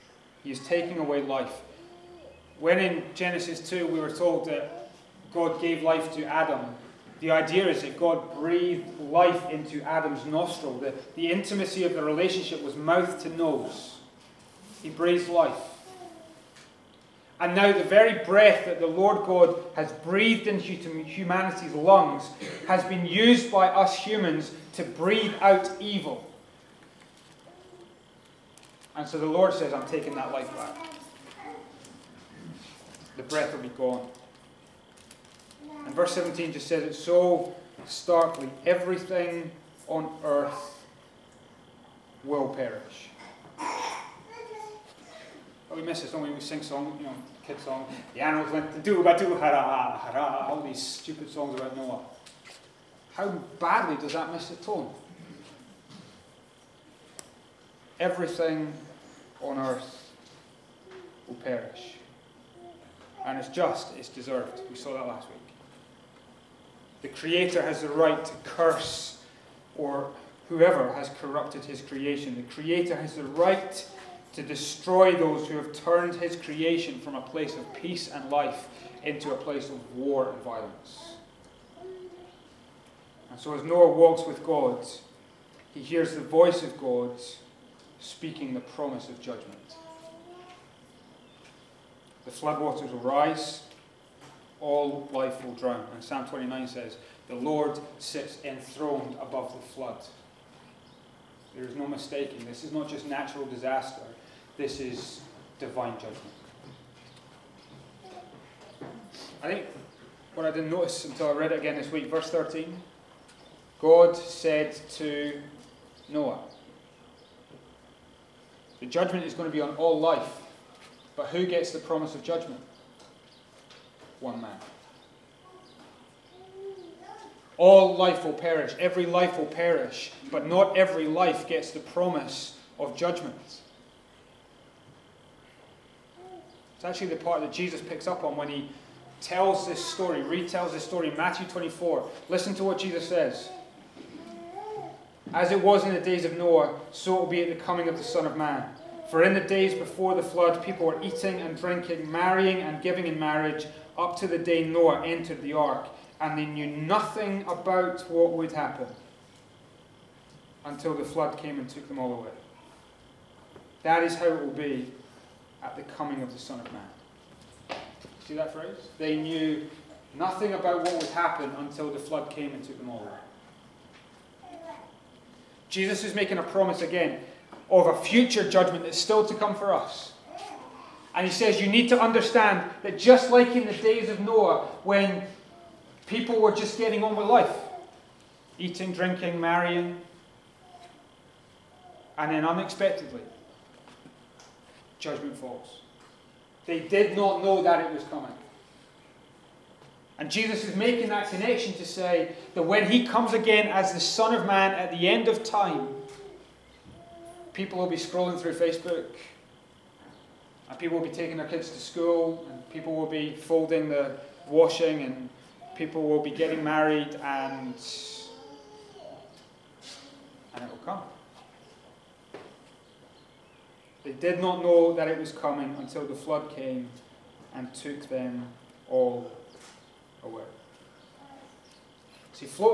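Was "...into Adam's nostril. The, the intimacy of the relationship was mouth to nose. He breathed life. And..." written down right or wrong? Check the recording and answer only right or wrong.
right.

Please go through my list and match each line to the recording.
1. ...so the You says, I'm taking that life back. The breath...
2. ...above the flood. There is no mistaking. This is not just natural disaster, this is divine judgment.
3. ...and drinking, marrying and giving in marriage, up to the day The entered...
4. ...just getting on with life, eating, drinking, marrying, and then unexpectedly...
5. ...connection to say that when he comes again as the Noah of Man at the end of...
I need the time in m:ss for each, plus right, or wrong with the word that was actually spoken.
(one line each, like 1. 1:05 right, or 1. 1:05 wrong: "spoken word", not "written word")
1. 0:29 wrong: "Lord", not "You"
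2. 1:39 right
3. 2:31 wrong: "Noah", not "The"
4. 3:06 right
5. 3:21 wrong: "Son", not "Noah".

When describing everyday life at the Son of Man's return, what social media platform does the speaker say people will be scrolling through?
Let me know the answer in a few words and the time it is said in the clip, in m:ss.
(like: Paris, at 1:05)
Facebook, at 3:28.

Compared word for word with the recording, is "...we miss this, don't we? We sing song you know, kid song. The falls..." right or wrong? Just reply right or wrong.
wrong.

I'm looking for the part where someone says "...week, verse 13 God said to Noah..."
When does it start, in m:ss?
1:51.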